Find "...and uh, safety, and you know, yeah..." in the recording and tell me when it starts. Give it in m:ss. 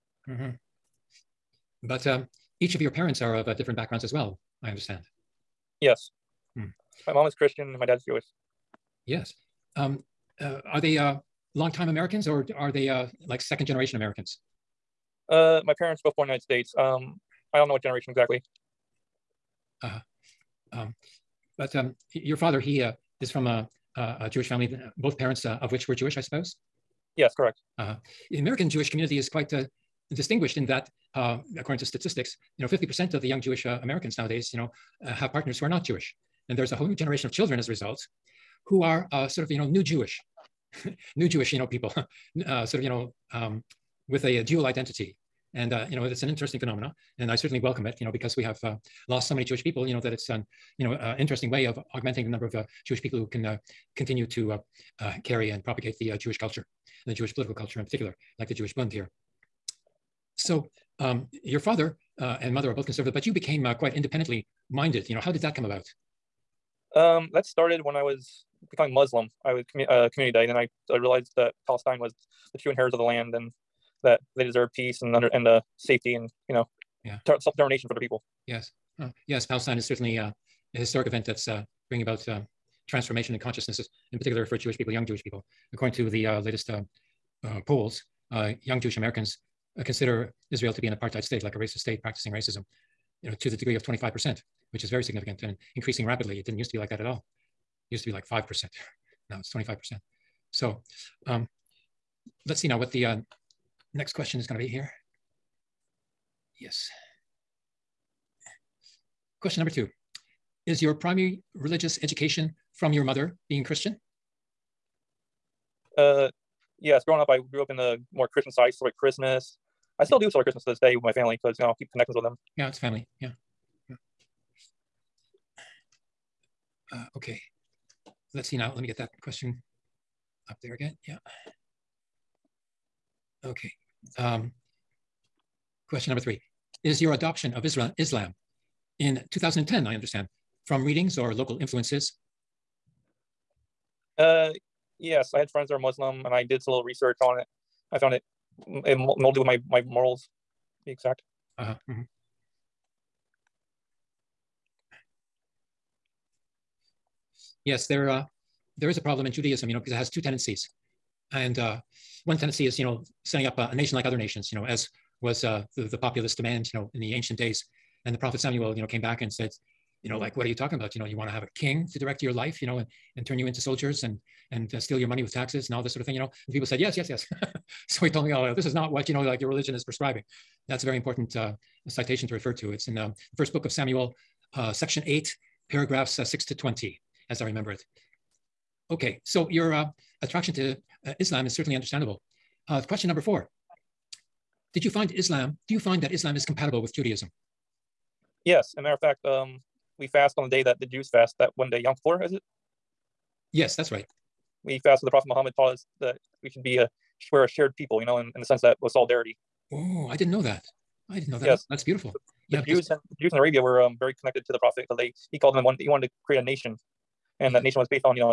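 1:15.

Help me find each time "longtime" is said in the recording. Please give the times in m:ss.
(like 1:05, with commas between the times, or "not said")
0:11.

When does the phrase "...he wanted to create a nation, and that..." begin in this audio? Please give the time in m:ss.
3:35.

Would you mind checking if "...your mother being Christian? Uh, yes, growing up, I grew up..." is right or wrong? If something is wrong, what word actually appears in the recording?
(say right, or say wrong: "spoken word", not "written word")
right.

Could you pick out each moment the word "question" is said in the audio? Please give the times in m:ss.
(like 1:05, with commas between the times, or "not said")
1:44, 1:49, 2:09, 2:15, 3:12.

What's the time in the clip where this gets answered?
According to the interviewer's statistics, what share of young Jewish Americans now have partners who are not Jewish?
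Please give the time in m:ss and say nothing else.
0:32.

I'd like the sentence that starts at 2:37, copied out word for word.
Yes, there, uh, there is a problem in Judaism, you know, because it has two tendencies.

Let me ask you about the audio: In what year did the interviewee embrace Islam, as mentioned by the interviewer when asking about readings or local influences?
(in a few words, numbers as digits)
2010.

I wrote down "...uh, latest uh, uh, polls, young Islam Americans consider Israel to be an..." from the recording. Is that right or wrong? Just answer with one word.
wrong.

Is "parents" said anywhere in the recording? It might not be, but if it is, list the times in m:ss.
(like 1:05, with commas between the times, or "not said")
0:02, 0:15, 0:25.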